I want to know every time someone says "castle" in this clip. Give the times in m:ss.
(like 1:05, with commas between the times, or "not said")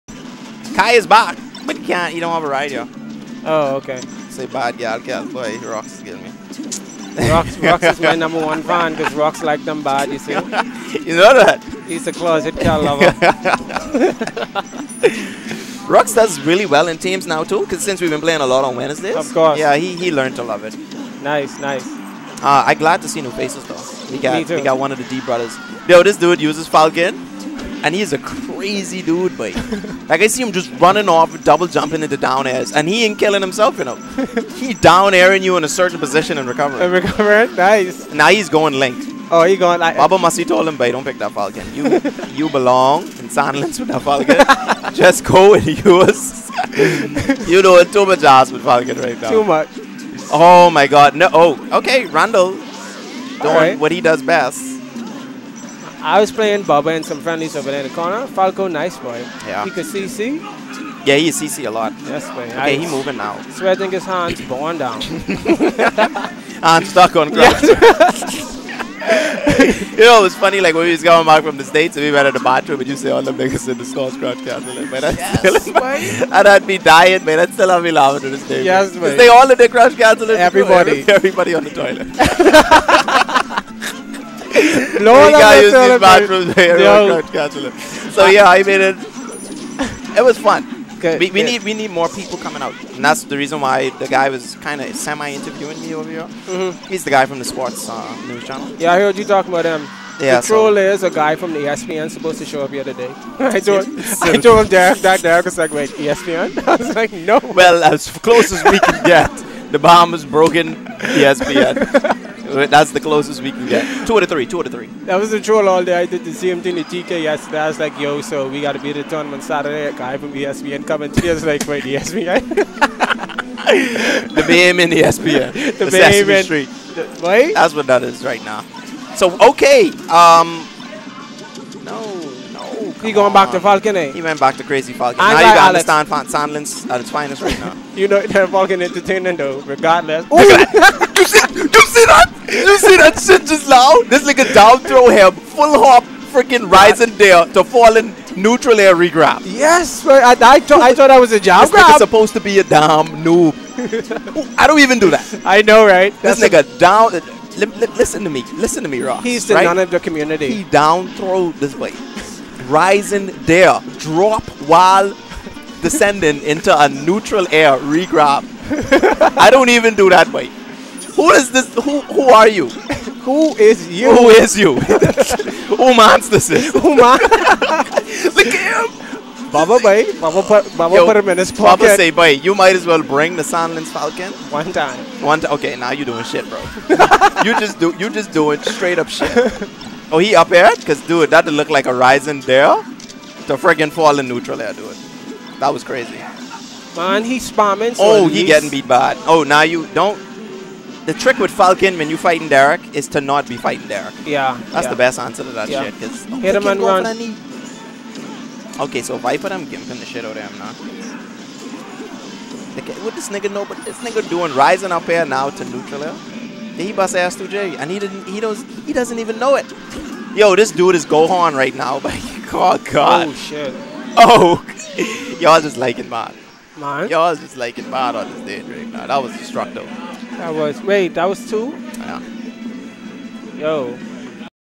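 1:14, 1:19.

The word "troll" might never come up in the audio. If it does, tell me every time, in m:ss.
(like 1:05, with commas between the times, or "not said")
1:40, 1:55.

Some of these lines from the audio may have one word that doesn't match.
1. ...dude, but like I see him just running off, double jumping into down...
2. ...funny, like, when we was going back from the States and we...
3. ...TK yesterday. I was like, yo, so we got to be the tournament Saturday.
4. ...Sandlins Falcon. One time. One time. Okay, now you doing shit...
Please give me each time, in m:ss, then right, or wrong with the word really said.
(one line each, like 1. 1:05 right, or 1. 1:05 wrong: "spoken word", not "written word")
1. 0:29 right
2. 1:10 right
3. 1:56 right
4. 3:03 right.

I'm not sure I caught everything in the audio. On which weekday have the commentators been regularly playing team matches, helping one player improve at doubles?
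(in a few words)
Wednesdays.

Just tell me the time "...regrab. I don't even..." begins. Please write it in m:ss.
2:47.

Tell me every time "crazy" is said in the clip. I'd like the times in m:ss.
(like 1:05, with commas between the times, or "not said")
0:28, 2:14, 3:15.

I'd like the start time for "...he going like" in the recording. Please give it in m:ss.
0:39.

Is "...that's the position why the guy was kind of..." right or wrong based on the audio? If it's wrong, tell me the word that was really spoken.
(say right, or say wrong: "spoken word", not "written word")
wrong: "reason", not "position".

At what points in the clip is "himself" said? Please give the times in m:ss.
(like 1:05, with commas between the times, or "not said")
0:33.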